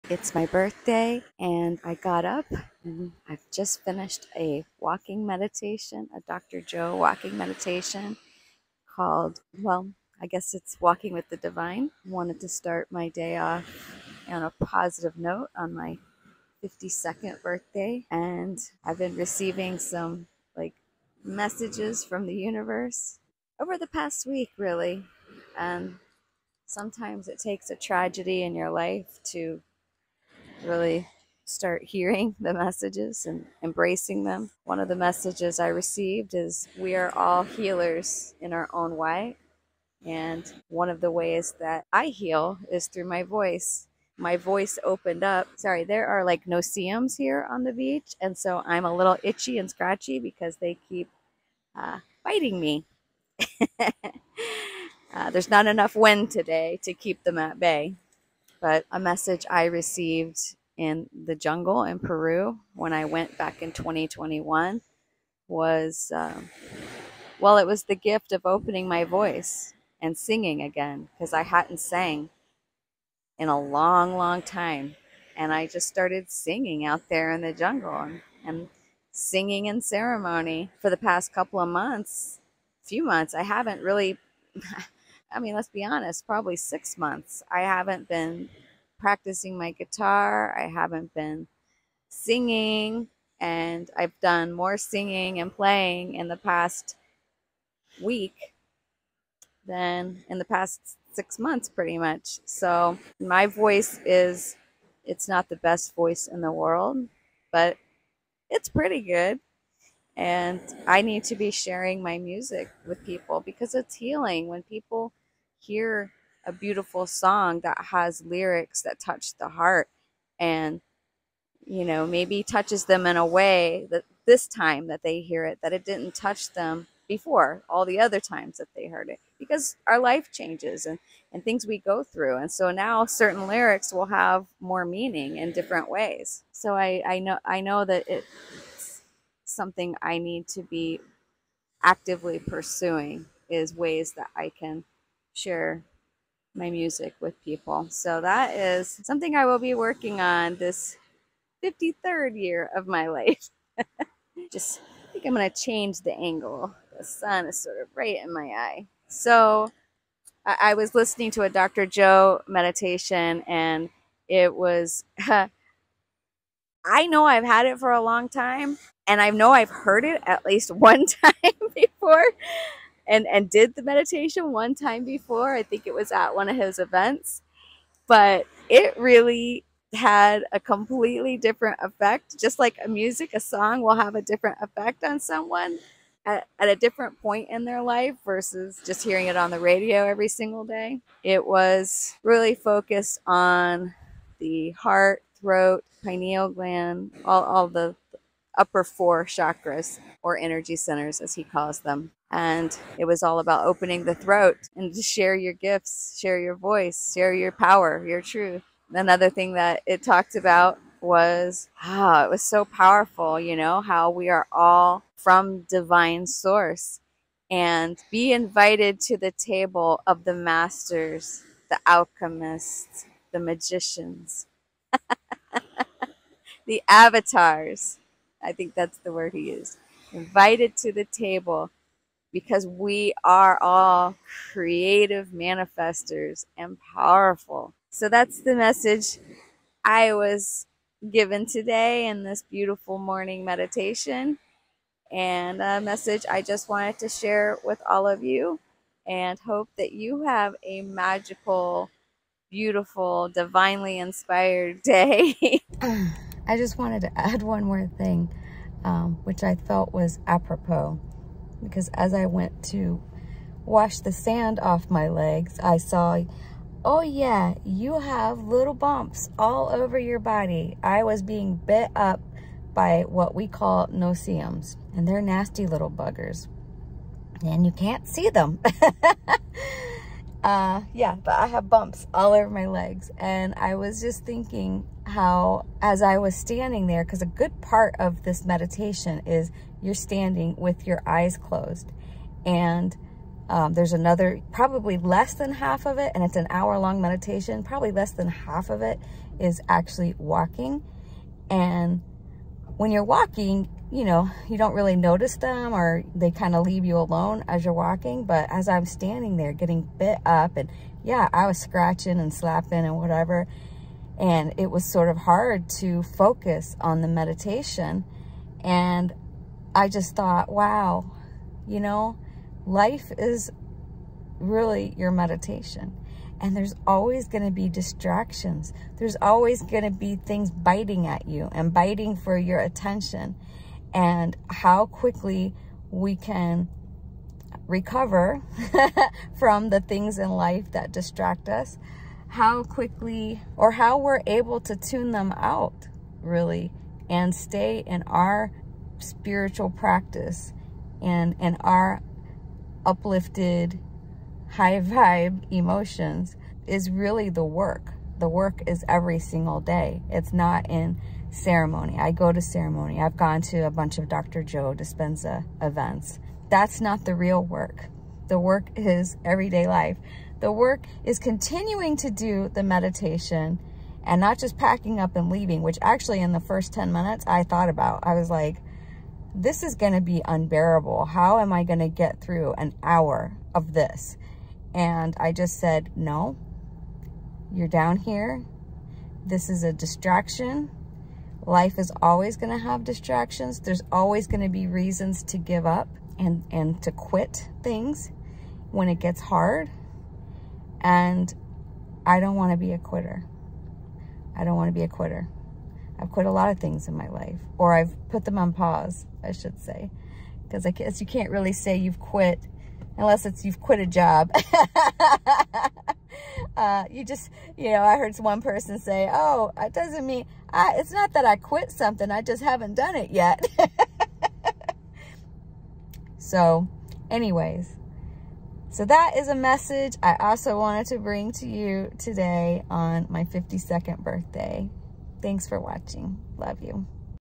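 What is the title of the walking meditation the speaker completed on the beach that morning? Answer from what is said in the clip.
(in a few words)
Walking with the Divine.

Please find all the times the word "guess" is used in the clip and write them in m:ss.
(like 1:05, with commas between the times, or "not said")
0:10, 6:50.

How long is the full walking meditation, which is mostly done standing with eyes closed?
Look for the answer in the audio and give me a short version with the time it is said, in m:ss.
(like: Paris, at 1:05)
1 hour, at 4:56.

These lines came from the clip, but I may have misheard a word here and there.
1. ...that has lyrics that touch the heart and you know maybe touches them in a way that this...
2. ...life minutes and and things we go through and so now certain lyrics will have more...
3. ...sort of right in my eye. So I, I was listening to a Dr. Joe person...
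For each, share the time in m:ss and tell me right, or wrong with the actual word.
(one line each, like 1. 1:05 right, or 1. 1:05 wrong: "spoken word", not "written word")
1. 1:57 right
2. 2:09 wrong: "changes", not "minutes"
3. 2:37 wrong: "meditation", not "person".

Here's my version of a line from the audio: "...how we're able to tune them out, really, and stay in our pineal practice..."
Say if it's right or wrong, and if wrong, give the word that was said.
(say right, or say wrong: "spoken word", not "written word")
wrong: "spiritual", not "pineal".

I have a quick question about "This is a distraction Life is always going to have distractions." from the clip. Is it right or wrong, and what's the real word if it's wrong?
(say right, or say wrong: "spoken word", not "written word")
right.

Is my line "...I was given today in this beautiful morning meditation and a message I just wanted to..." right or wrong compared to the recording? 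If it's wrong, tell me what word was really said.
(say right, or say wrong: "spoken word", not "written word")
right.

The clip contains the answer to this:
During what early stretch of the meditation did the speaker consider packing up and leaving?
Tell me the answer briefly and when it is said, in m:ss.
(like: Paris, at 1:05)
first 10 minutes, at 6:16.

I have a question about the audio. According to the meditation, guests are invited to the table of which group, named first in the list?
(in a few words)
the masters.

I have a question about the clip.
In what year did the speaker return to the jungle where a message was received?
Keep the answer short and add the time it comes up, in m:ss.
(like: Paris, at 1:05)
2021, at 1:03.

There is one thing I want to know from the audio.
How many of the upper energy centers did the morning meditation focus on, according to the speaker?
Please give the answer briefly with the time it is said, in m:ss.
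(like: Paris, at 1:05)
4, at 3:18.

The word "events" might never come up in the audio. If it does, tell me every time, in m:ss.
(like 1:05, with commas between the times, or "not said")
2:56, 6:05.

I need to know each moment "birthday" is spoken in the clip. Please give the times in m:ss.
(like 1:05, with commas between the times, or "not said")
0:00, 0:17, 7:13.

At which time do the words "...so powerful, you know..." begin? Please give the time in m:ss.
3:32.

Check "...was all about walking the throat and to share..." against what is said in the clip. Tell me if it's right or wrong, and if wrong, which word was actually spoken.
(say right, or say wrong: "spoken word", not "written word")
wrong: "opening", not "walking".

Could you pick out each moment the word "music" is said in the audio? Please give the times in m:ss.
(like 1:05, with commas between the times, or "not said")
1:52, 2:26, 3:02.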